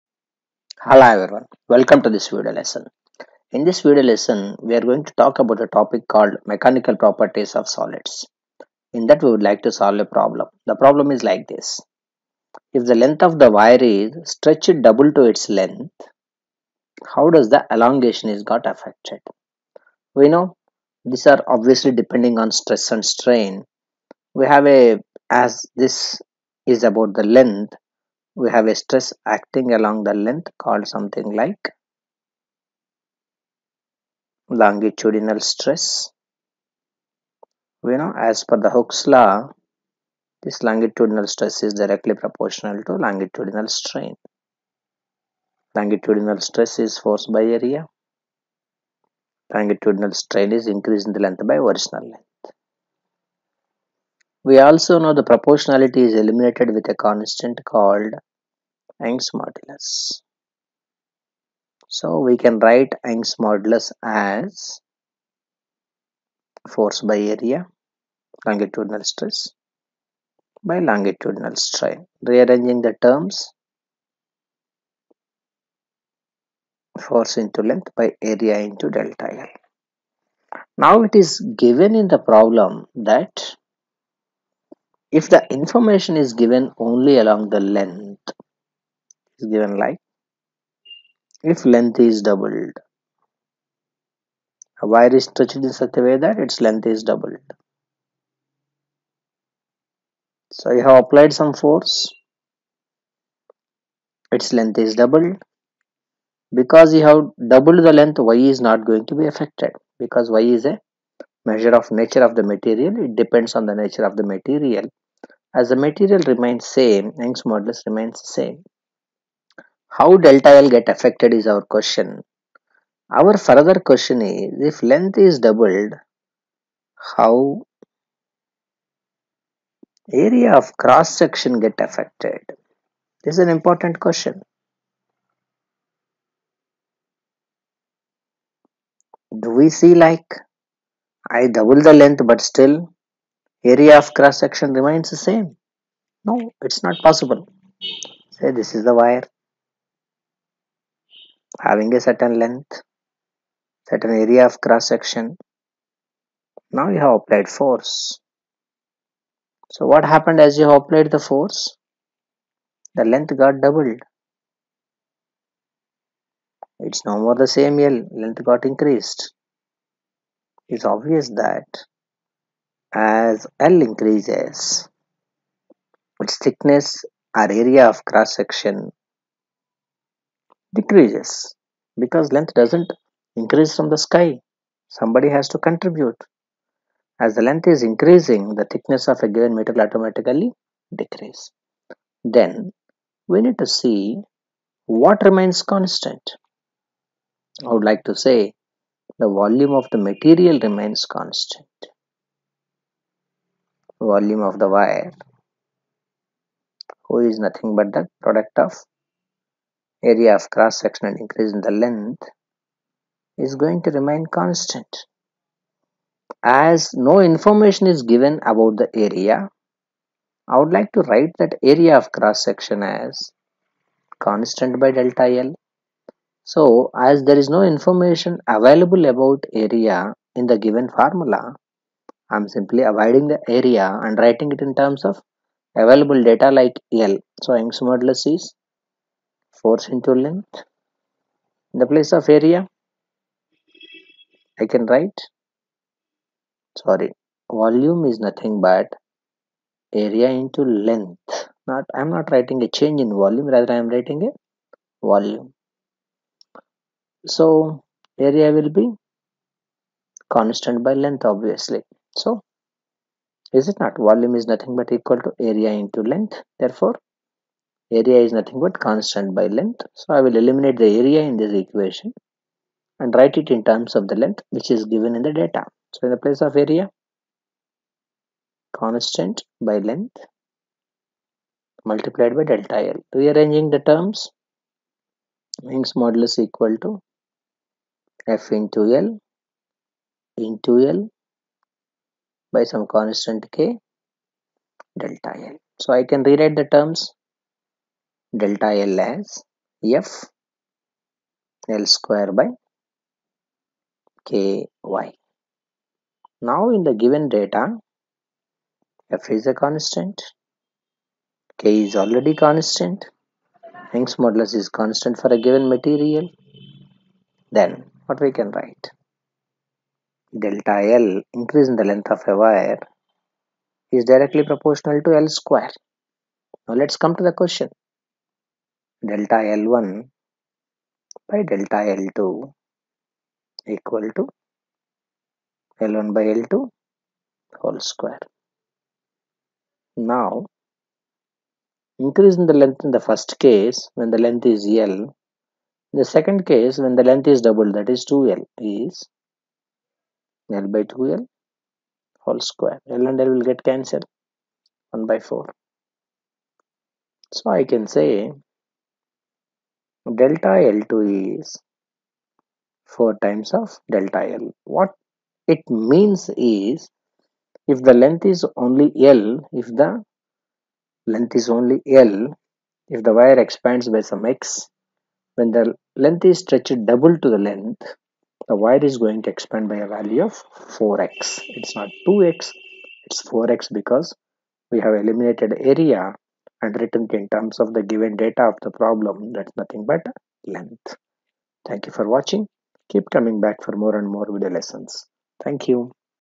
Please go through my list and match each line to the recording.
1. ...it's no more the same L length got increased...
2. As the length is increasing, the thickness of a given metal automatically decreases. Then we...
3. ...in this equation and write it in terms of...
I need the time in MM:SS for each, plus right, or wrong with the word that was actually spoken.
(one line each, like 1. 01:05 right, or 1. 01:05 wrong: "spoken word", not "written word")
1. 02:46 right
2. 03:07 right
3. 04:31 right.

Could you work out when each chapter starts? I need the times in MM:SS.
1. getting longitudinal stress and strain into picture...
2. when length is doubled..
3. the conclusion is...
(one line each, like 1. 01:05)
1. 01:00
2. 02:00
3. 05:00.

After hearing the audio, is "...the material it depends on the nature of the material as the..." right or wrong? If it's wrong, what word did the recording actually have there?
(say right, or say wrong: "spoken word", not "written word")
right.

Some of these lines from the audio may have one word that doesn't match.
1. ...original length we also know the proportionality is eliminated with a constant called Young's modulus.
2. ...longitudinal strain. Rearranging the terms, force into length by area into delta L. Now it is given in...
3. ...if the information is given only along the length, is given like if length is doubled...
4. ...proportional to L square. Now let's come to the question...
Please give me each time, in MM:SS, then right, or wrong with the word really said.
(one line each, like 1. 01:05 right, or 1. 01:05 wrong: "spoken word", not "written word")
1. 00:51 right
2. 01:10 right
3. 01:25 right
4. 05:24 right.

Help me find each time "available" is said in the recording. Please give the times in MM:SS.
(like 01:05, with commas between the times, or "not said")
03:48, 03:55.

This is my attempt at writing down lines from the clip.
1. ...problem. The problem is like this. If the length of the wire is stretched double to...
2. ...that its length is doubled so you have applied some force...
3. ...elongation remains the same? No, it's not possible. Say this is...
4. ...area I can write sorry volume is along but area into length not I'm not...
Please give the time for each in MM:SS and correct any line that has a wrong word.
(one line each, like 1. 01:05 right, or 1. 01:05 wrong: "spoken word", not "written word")
1. 00:10 right
2. 01:36 right
3. 02:24 wrong: "section", not "elongation"
4. 04:02 wrong: "nothing", not "along".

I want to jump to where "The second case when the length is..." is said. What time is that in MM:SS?
05:45.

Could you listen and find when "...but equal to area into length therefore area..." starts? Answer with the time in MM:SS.
04:24.